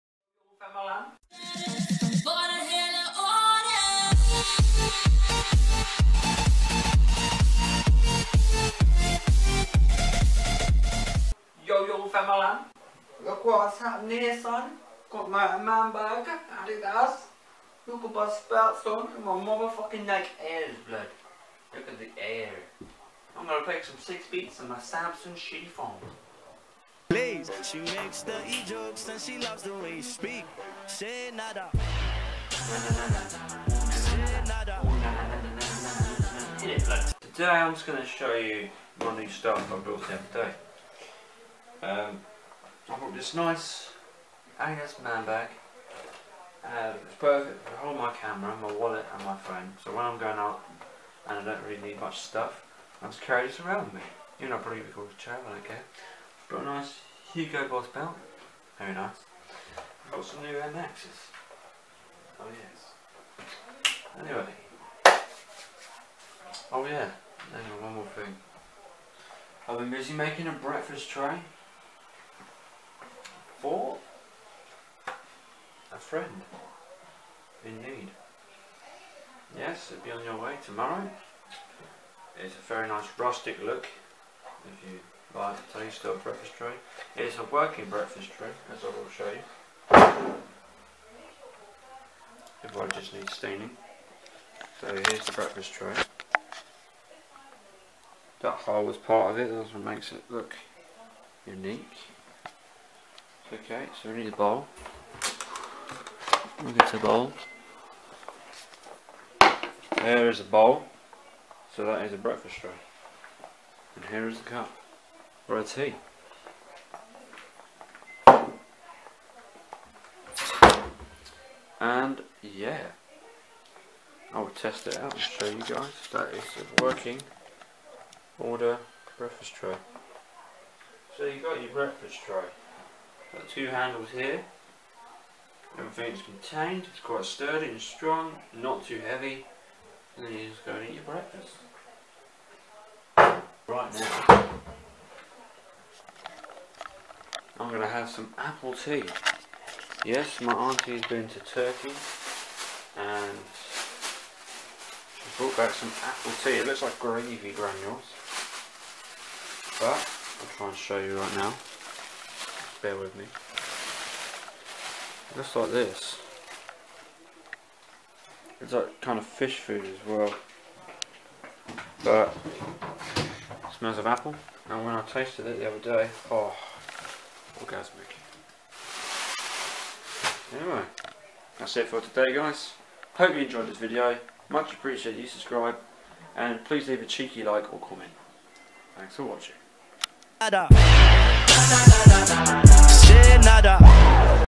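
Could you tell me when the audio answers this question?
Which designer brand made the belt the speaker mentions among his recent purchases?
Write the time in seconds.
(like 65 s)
57 s.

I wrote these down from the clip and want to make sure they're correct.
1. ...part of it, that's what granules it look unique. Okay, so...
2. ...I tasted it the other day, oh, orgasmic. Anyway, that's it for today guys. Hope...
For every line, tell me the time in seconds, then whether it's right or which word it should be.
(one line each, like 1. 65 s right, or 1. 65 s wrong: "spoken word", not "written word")
1. 98 s wrong: "makes", not "granules"
2. 174 s right.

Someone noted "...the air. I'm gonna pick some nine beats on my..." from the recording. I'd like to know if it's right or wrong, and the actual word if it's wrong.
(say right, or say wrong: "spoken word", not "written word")
wrong: "six", not "nine".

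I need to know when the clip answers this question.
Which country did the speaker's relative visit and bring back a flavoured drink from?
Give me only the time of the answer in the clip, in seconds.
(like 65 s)
151 s.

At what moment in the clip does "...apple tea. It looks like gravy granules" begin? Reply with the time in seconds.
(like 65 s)
156 s.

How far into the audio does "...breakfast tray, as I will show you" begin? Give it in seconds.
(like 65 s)
87 s.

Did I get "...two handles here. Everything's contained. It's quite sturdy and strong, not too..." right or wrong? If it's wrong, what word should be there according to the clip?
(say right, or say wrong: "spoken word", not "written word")
right.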